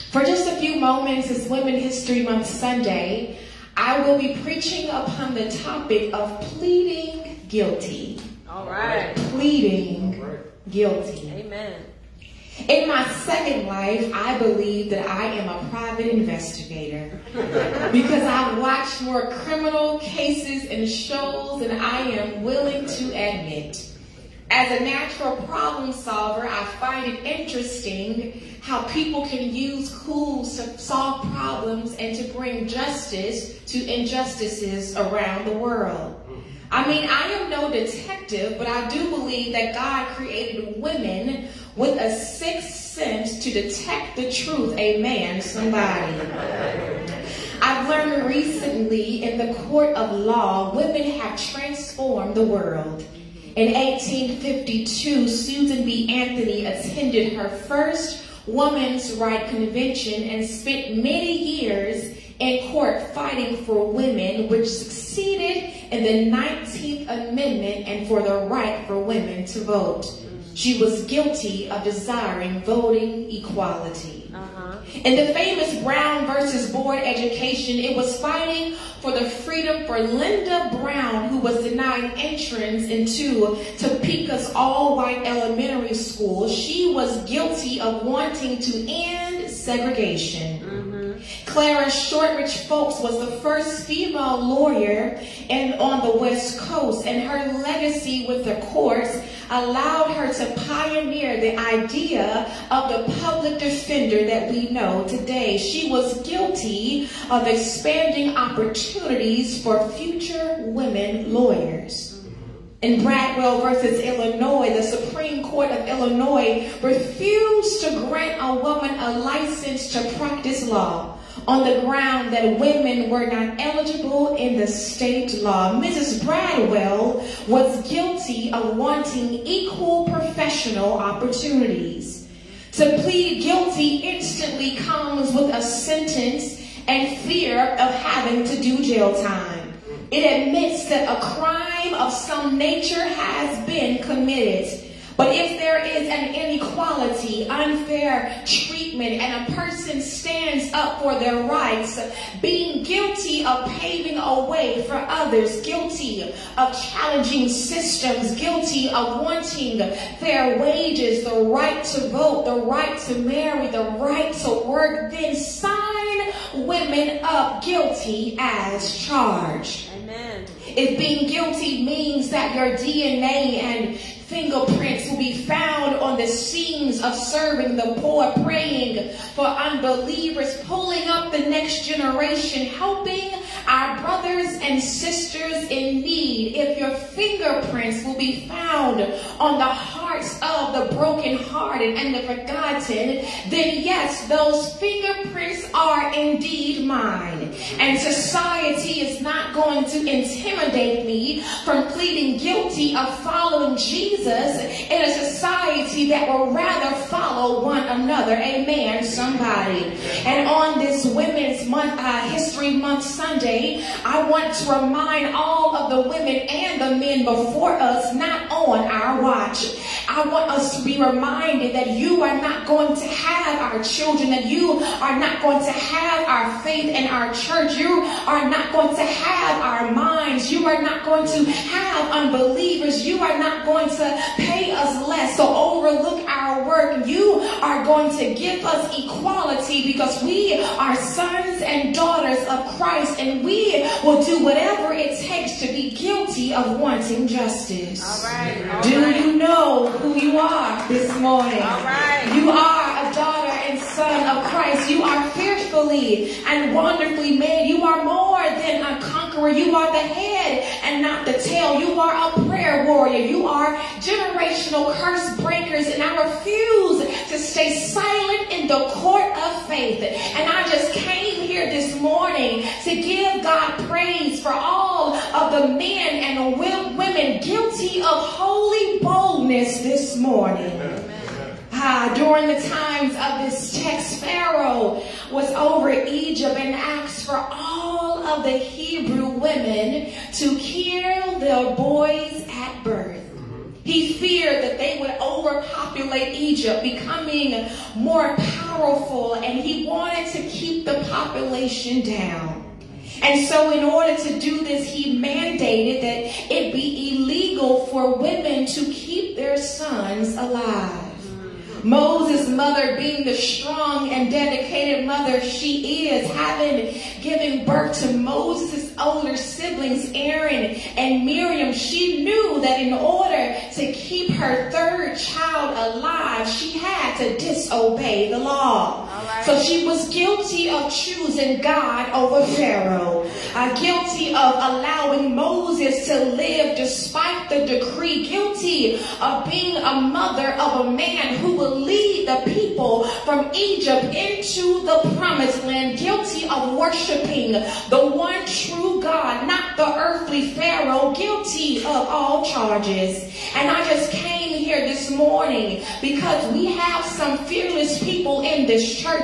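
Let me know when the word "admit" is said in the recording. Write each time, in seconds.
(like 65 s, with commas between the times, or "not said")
23 s, 140 s.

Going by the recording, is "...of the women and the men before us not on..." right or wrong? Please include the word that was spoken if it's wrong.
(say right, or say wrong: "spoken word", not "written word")
right.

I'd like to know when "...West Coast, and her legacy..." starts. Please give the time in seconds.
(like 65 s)
96 s.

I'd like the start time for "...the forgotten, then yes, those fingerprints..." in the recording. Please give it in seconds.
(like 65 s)
192 s.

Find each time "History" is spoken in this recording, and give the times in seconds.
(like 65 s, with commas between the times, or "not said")
1 s, 212 s.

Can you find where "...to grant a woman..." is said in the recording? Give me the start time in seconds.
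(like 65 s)
117 s.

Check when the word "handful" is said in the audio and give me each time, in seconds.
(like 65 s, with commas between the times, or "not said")
not said.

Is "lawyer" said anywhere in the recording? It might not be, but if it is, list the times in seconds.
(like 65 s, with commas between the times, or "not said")
94 s, 111 s.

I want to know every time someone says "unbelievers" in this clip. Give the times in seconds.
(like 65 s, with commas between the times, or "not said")
179 s, 232 s.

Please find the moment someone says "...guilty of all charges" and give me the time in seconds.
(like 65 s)
351 s.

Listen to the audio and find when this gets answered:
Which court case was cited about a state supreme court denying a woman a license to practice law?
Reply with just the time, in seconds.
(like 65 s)
113 s.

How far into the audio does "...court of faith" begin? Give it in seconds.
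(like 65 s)
268 s.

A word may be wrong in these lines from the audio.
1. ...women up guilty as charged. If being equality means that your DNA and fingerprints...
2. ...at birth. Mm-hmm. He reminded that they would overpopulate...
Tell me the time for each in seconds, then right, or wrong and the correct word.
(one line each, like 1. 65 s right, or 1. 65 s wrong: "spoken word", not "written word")
1. 166 s wrong: "guilty", not "equality"
2. 292 s wrong: "feared", not "reminded".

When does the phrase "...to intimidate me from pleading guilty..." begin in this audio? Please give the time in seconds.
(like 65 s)
199 s.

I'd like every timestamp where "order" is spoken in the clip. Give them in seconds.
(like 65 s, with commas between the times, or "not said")
303 s, 322 s.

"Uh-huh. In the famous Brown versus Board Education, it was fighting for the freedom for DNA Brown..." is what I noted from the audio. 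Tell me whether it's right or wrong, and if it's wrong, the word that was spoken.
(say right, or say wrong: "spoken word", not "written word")
wrong: "Linda", not "DNA".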